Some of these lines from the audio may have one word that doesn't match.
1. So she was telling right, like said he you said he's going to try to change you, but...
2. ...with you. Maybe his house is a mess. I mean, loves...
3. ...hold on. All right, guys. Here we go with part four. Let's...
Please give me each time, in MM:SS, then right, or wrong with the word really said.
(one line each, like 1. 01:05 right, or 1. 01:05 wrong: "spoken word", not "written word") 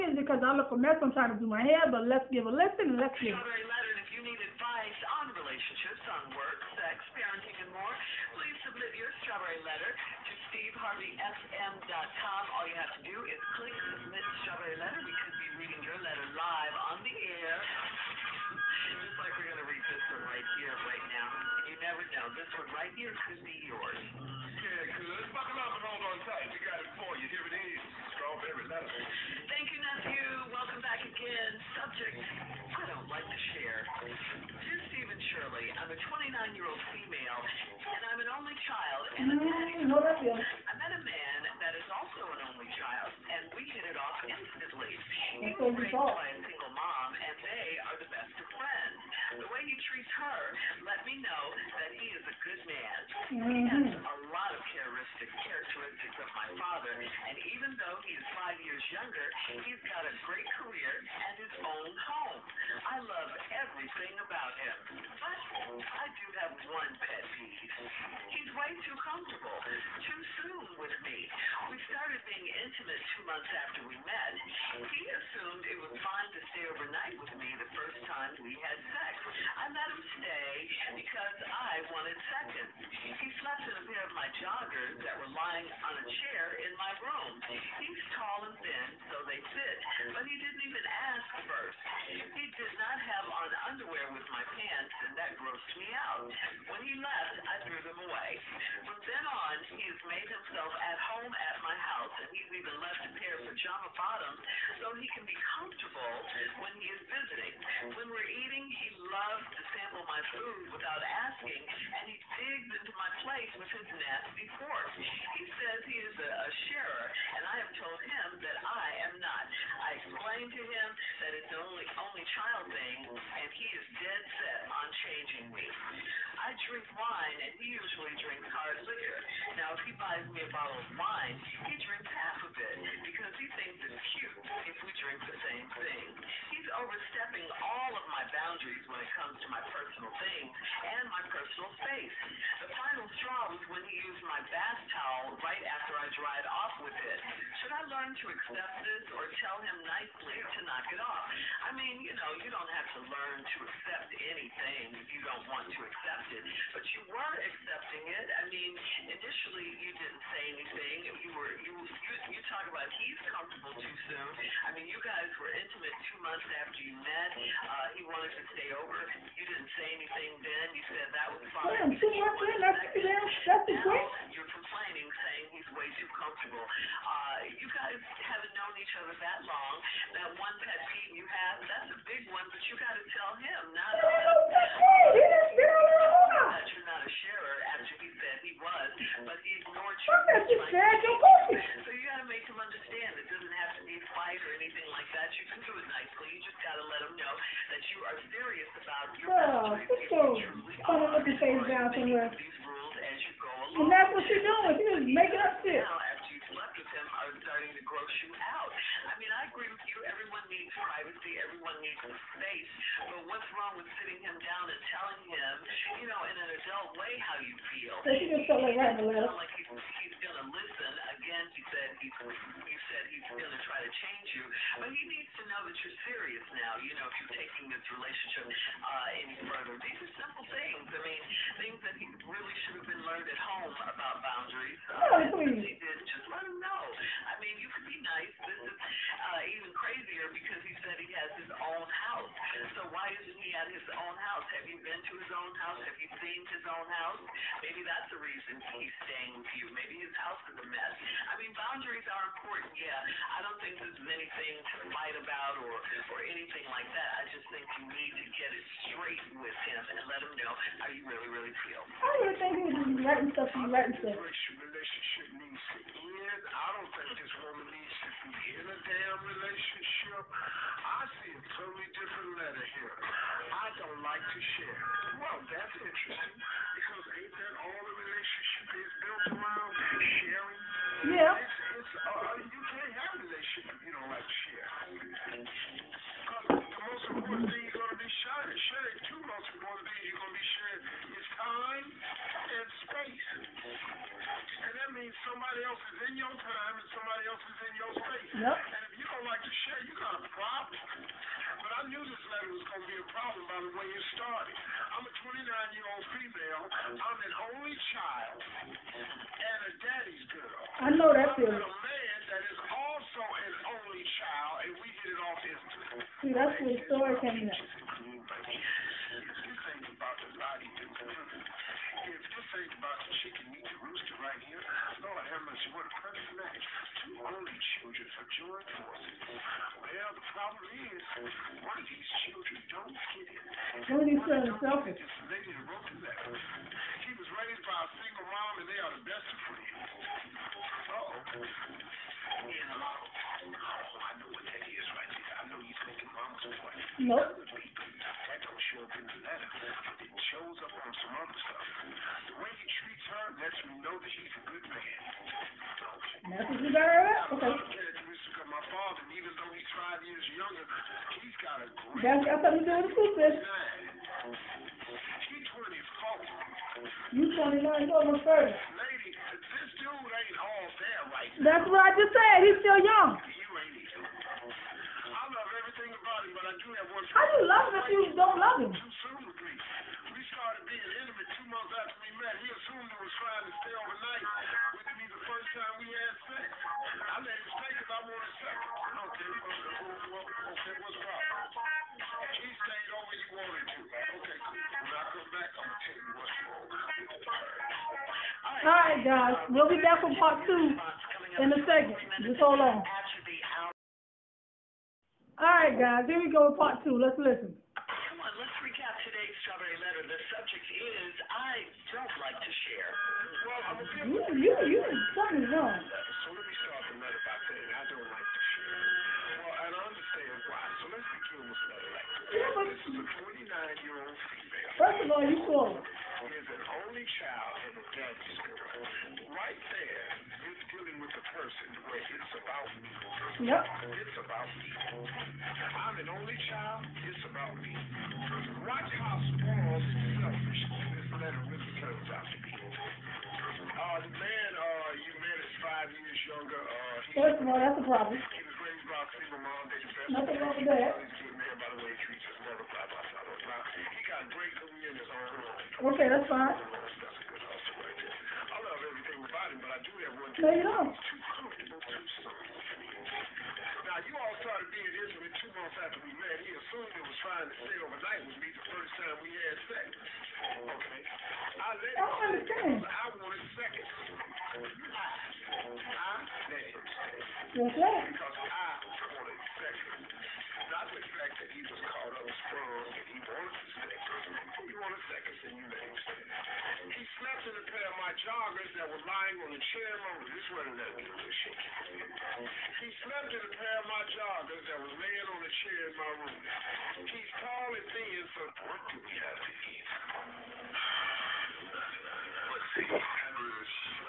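1. 03:38 right
2. 04:09 wrong: "boundaries", not "loves"
3. 06:42 wrong: "two", not "four".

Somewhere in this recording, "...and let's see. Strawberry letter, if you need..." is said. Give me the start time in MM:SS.
00:02.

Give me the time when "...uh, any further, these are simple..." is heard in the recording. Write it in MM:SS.
03:48.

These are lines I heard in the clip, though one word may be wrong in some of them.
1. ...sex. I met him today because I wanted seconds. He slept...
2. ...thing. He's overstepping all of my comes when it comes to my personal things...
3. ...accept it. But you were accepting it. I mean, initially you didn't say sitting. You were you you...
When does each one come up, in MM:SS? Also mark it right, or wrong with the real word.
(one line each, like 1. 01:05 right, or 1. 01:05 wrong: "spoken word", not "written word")
1. 01:18 right
2. 02:15 wrong: "boundaries", not "comes"
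3. 02:35 wrong: "anything", not "sitting".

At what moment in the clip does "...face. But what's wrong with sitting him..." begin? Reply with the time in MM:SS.
03:32.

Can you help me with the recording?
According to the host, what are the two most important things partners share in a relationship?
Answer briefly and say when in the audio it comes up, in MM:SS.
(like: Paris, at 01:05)
time and space, at 04:51.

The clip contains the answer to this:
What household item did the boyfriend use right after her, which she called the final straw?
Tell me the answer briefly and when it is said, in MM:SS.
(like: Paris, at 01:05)
bath towel, at 02:24.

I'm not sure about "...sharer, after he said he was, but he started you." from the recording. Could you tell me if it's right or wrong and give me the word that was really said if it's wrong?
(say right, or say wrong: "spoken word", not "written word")
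wrong: "ignored", not "started".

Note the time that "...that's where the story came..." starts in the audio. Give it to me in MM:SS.
05:16.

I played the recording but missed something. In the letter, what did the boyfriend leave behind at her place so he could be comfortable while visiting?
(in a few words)
pajama bottoms.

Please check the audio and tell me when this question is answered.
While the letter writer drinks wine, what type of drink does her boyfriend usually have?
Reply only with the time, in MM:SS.
02:08.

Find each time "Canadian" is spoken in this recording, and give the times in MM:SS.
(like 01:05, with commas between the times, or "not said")
not said.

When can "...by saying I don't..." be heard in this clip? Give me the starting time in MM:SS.
06:57.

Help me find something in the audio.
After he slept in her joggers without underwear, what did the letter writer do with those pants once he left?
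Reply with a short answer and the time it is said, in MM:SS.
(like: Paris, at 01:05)
threw them away, at 01:37.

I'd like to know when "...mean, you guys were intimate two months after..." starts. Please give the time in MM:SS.
02:44.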